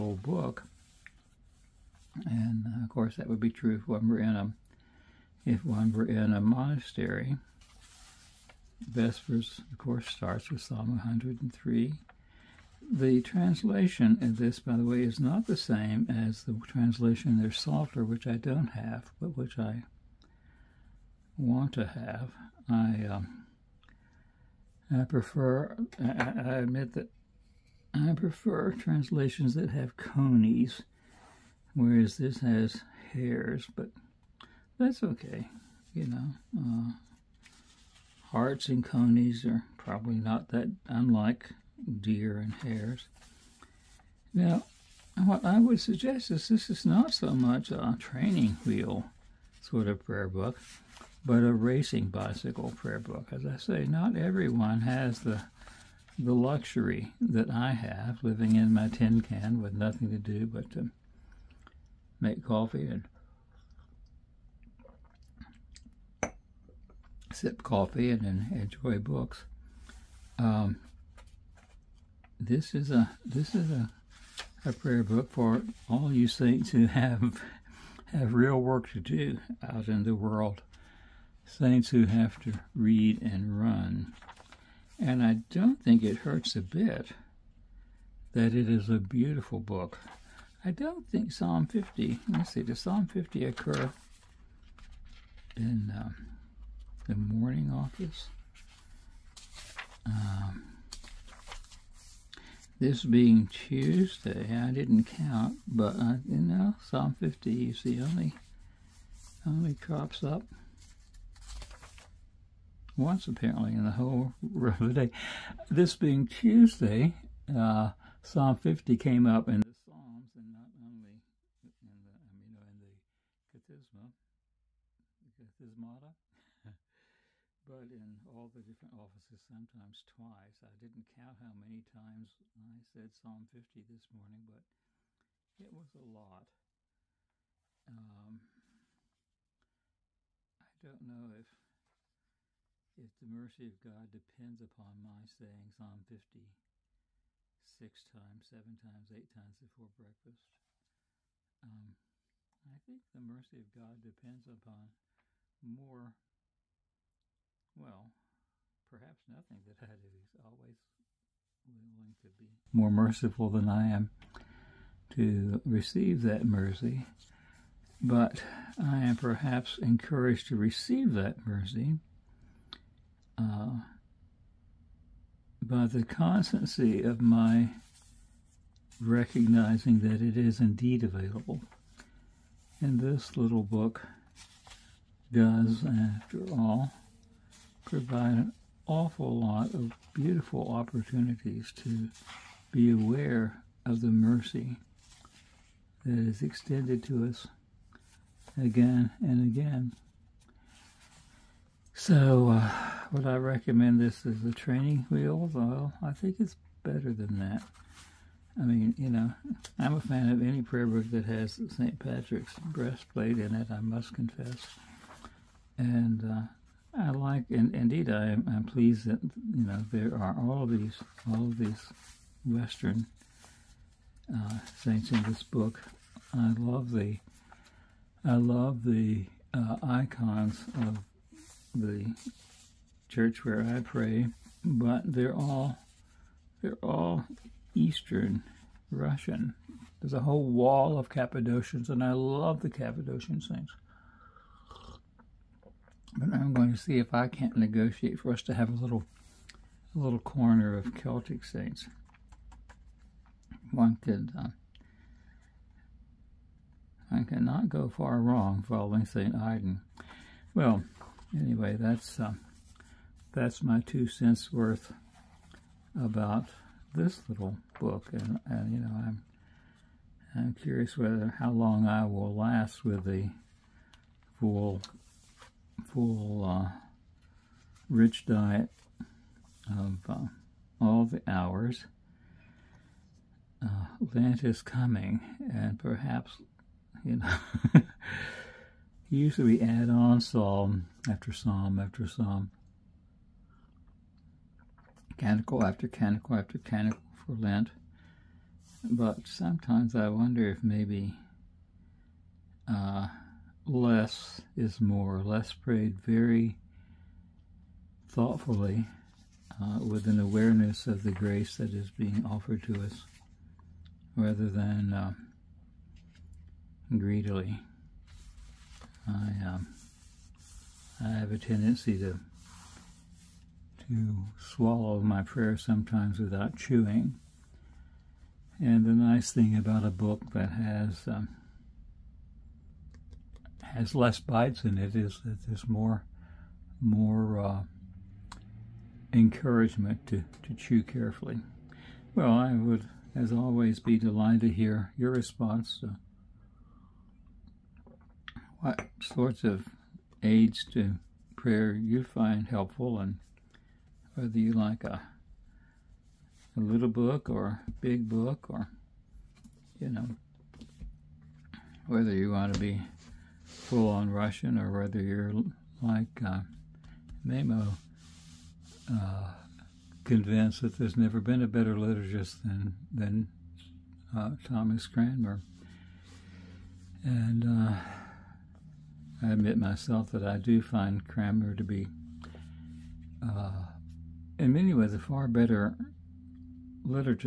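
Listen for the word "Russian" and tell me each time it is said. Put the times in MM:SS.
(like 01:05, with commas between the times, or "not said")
03:58, 06:04.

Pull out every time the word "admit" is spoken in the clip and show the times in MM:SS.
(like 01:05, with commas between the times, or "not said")
00:26, 06:19.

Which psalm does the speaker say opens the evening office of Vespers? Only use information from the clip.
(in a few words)
Psalm 103.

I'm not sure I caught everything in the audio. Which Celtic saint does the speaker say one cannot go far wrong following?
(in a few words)
St. Aidan.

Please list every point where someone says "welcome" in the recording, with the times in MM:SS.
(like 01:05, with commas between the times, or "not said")
not said.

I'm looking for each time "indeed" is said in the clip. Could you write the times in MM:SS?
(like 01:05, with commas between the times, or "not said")
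03:00, 03:37.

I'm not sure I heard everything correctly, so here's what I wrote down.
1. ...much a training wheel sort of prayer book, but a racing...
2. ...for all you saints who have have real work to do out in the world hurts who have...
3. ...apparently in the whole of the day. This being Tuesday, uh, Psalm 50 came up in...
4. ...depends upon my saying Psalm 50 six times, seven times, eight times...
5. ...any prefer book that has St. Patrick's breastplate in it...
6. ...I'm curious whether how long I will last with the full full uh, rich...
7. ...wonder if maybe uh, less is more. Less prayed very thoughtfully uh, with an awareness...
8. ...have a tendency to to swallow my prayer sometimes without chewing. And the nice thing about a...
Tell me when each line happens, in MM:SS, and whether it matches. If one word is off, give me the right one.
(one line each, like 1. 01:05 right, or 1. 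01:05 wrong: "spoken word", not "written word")
1. 00:47 right
2. 01:15 wrong: "saints", not "hurts"
3. 01:53 right
4. 02:24 right
5. 03:30 wrong: "prayer", not "prefer"
6. 04:30 right
7. 05:00 right
8. 05:21 right.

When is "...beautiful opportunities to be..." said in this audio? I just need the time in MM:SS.
03:10.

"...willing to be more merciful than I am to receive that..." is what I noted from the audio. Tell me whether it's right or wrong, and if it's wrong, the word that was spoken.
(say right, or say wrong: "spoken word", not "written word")
right.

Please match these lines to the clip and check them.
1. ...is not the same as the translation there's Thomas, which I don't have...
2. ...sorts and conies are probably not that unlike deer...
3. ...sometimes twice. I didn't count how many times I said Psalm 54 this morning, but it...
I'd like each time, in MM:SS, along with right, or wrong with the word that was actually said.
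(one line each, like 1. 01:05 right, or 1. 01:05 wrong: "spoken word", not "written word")
1. 00:15 wrong: "Psalter", not "Thomas"
2. 00:38 wrong: "harts", not "sorts"
3. 02:09 wrong: "50", not "54".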